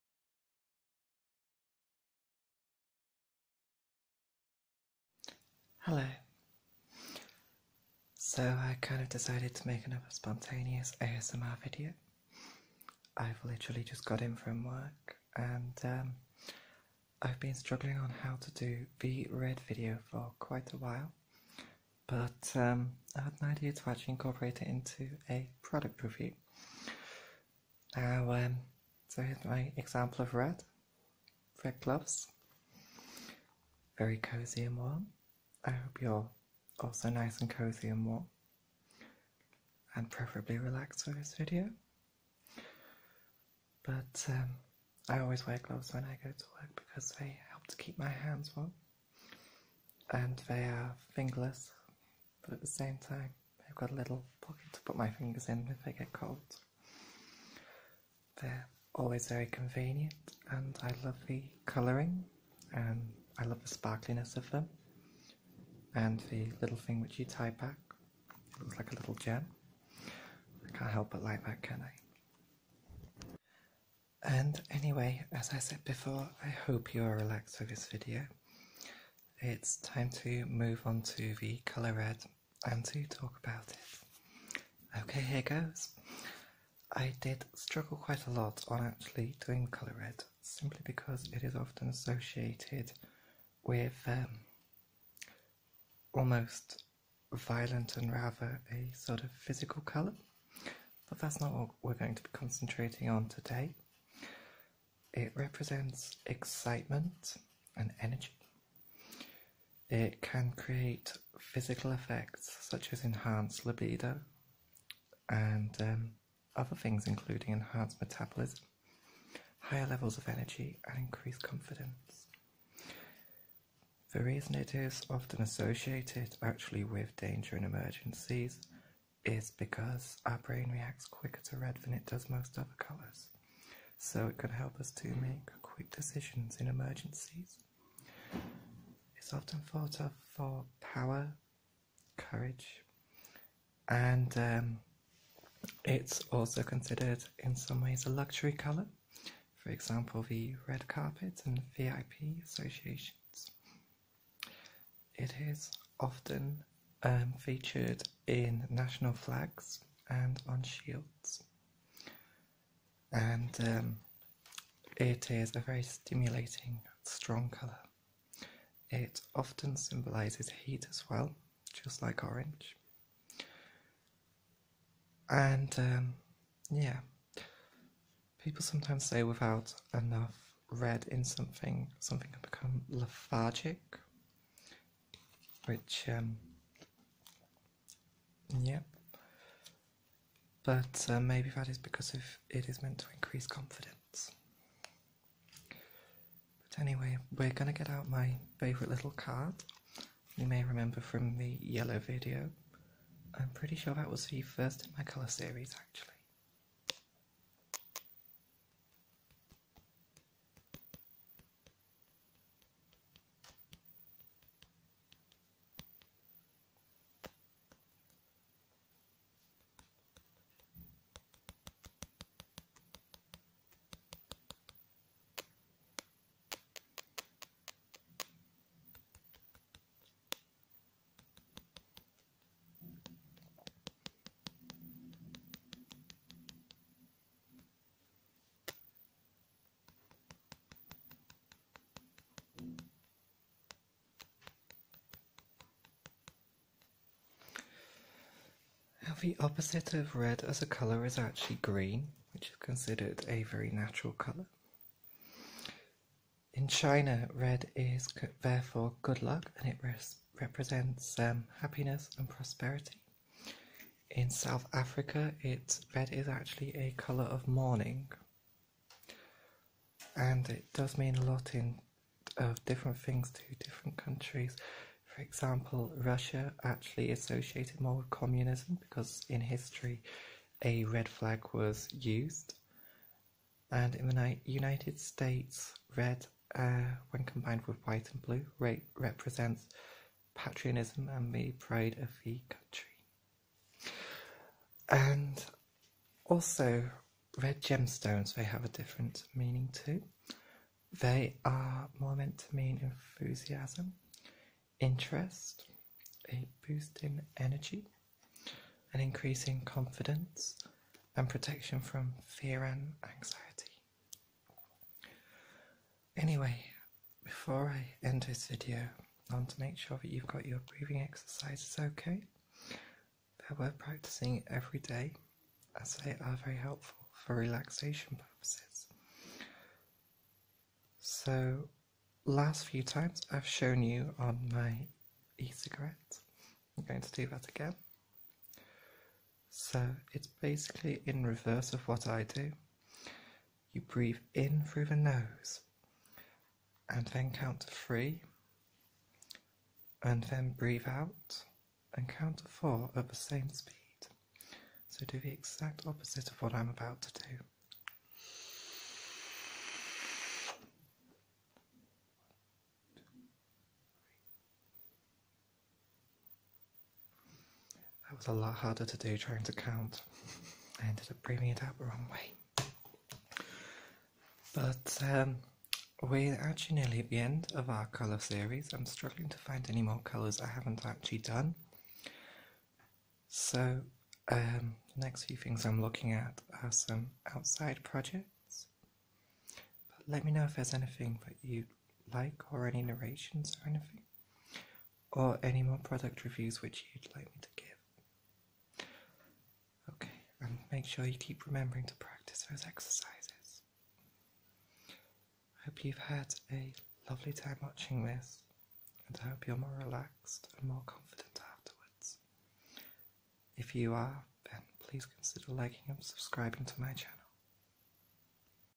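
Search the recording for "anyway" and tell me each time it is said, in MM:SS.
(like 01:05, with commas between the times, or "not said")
01:14, 03:16, 05:16.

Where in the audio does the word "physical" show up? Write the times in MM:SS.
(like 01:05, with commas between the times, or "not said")
01:39, 01:51.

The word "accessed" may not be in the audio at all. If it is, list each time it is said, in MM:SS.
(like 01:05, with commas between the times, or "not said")
not said.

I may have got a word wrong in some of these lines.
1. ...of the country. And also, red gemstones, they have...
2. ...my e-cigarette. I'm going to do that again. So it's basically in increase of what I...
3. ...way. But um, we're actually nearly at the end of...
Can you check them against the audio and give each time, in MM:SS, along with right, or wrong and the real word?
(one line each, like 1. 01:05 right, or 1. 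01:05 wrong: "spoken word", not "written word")
1. 04:52 right
2. 05:34 wrong: "reverse", not "increase"
3. 06:12 right.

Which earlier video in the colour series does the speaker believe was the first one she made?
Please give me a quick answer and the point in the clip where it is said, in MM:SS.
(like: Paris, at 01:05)
yellow, at 03:21.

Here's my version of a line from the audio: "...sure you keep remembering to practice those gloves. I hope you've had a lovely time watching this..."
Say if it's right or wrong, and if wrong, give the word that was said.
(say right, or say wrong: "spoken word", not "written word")
wrong: "exercises", not "gloves".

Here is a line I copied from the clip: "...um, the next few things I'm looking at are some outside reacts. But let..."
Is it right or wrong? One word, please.
wrong.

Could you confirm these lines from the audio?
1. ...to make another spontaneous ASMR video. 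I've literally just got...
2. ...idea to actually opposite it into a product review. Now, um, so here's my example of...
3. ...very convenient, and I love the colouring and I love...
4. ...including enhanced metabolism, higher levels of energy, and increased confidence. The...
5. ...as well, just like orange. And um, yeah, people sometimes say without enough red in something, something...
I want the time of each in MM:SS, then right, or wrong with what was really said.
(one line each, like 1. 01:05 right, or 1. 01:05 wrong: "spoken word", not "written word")
1. 00:09 right
2. 00:23 wrong: "incorporate", not "opposite"
3. 00:59 right
4. 01:57 right
5. 02:50 right.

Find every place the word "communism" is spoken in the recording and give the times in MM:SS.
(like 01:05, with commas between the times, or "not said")
04:38.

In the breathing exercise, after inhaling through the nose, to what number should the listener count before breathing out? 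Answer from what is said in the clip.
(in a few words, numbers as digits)
3.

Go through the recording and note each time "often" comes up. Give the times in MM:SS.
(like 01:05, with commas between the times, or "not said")
01:31, 02:05, 02:19, 02:35, 02:49.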